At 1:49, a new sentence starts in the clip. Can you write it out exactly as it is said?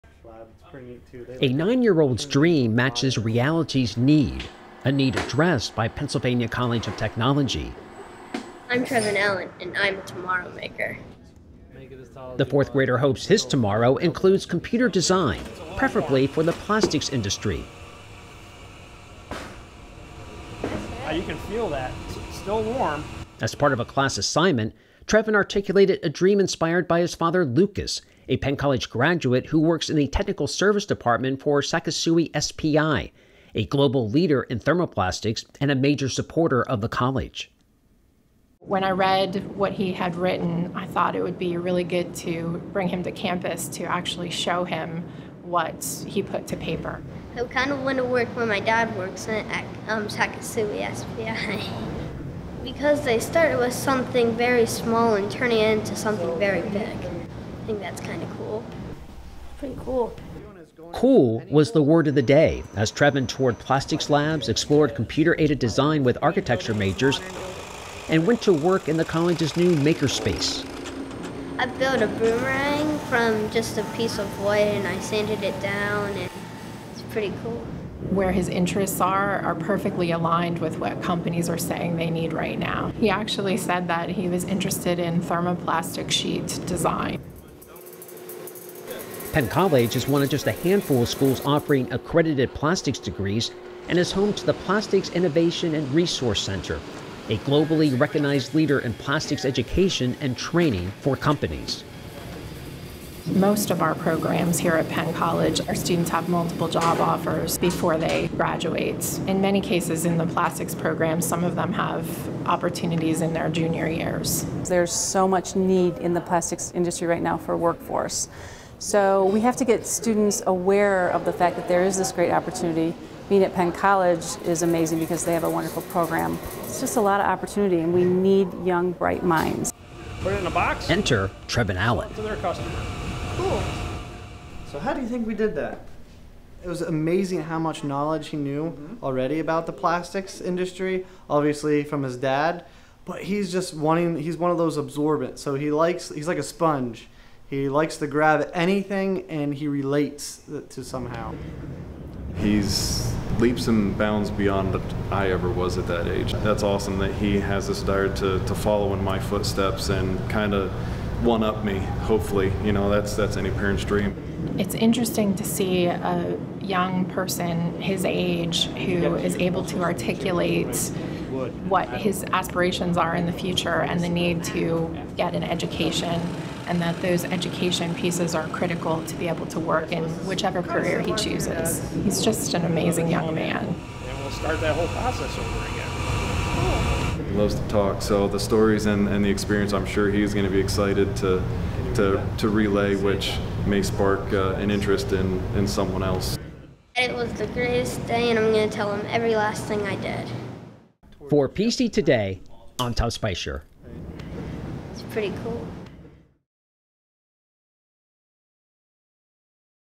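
In many cases, in the plastics program, some of them have opportunities in their junior years.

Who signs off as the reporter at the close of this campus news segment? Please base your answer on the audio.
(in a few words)
Tom Spicer.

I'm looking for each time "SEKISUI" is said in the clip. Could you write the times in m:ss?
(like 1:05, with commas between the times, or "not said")
0:31, 0:50.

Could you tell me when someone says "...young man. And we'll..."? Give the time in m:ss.
3:03.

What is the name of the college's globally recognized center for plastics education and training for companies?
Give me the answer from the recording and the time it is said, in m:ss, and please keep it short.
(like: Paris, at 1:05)
Plastics Innovation and Resource Center, at 1:34.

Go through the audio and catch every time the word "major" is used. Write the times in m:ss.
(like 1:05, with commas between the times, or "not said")
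0:35, 1:06.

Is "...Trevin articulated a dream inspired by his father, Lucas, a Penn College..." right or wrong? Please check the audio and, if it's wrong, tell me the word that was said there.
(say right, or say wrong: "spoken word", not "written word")
right.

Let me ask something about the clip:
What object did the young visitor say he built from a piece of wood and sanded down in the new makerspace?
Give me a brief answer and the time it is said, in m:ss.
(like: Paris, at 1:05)
A boomerang, at 1:12.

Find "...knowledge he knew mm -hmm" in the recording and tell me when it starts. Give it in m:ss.
2:17.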